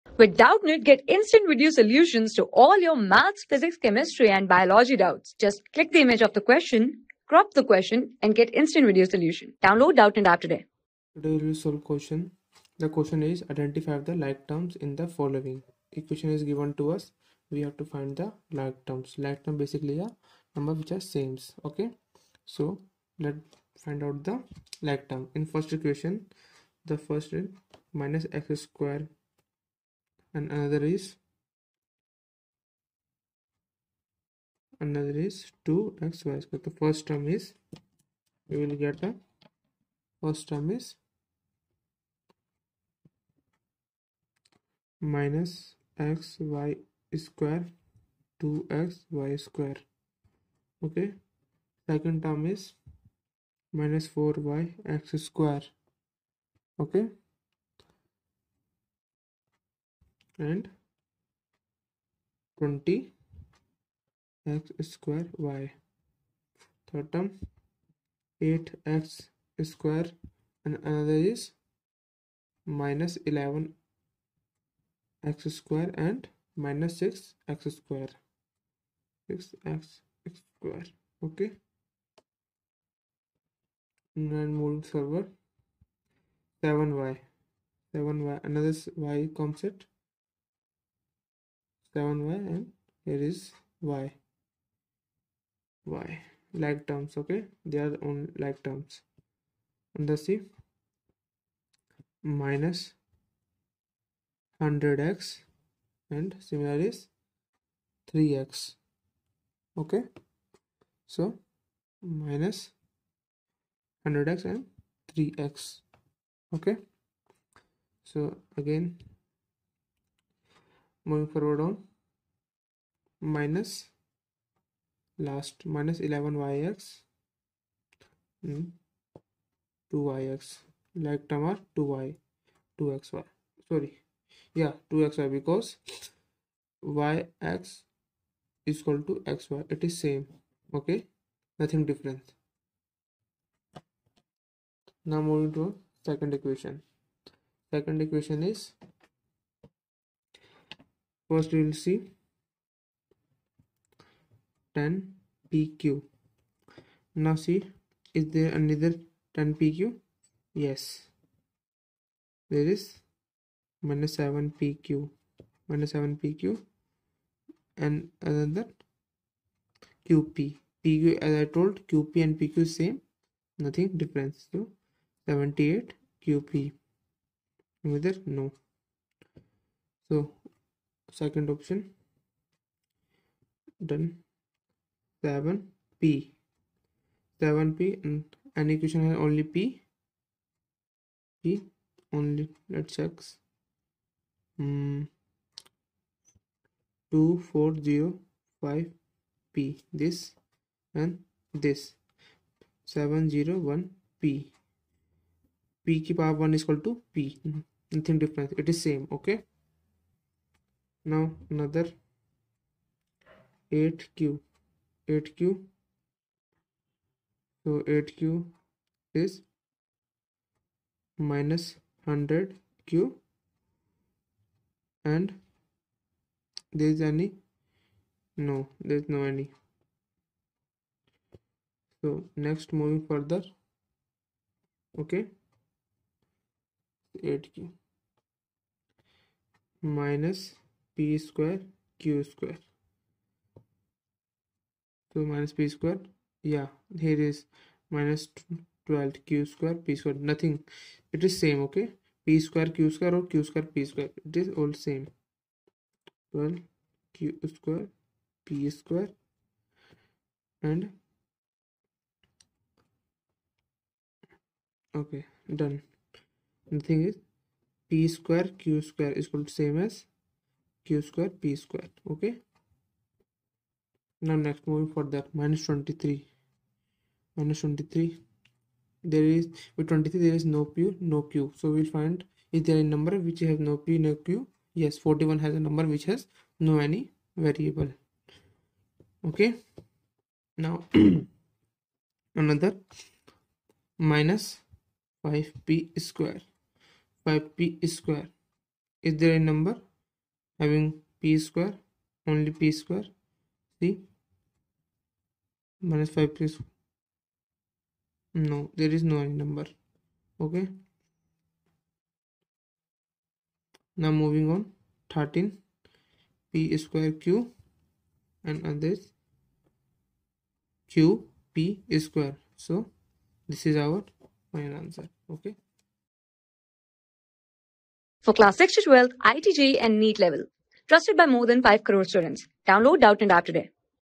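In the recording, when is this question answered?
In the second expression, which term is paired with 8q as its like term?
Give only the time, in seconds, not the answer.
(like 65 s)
221 s.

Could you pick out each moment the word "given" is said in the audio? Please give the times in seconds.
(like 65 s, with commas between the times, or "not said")
16 s.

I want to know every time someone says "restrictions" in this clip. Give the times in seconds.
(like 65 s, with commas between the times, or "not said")
not said.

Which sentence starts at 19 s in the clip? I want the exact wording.
Like term basically a number which are sames.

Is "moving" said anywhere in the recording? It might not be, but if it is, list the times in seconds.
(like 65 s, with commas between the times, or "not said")
121 s, 145 s, 232 s, 274 s, 314 s.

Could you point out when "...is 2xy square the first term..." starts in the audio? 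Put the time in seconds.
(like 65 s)
35 s.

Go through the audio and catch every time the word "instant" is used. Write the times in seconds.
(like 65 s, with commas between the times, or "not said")
1 s, 8 s.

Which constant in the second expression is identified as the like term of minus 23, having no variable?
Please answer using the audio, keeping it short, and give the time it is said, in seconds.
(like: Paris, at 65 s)
41, at 284 s.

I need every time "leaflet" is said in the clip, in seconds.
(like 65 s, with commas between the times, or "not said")
not said.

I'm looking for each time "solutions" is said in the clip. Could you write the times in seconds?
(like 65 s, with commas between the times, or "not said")
1 s, 9 s.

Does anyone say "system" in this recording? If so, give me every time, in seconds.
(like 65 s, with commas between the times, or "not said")
not said.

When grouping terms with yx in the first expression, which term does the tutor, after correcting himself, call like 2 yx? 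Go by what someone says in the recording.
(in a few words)
2xy.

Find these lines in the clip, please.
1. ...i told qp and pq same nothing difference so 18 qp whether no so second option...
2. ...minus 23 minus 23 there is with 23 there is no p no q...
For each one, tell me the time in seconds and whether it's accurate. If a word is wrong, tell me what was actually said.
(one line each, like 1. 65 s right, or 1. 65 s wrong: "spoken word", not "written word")
1. 171 s wrong: "78", not "18"
2. 275 s right.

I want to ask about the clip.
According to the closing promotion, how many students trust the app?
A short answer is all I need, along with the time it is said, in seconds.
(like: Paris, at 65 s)
more than 5 crore, at 331 s.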